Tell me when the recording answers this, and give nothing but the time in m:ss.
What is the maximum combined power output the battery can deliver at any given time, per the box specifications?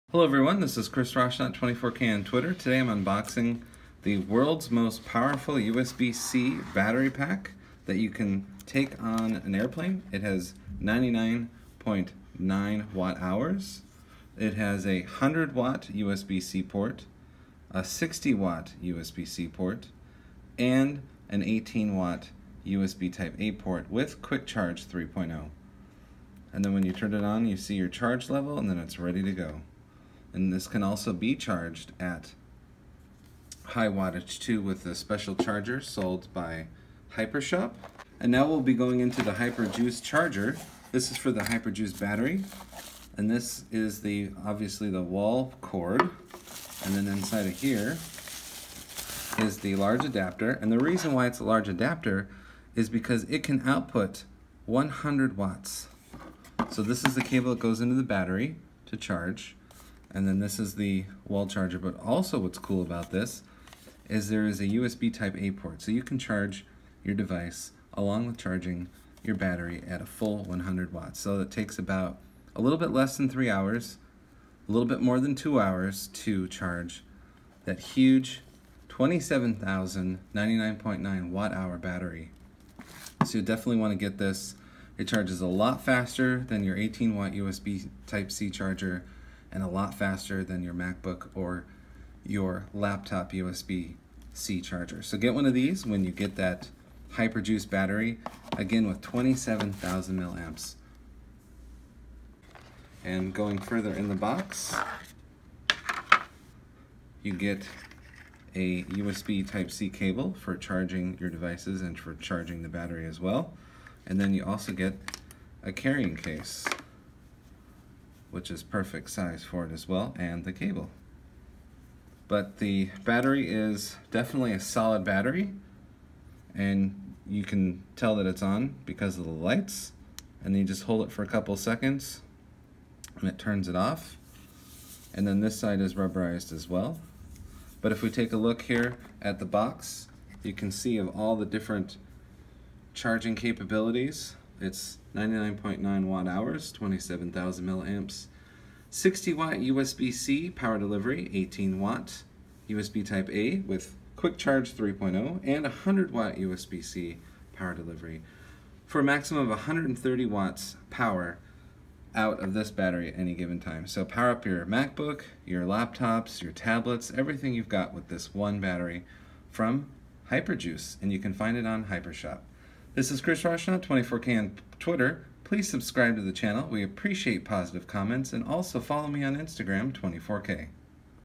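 2:39.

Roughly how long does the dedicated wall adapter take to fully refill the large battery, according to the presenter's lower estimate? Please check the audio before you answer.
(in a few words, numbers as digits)
A little more than 2 hours.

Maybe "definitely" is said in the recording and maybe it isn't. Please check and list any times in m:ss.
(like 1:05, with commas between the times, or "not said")
1:23, 2:04.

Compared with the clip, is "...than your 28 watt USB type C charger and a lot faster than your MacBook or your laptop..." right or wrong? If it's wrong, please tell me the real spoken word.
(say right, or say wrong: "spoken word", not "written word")
wrong: "18", not "28".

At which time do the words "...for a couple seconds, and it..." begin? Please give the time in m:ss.
2:11.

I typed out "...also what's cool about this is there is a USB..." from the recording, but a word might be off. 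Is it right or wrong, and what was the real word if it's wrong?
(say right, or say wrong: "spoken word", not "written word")
right.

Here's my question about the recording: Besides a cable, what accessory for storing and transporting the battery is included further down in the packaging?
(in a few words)
A carrying case.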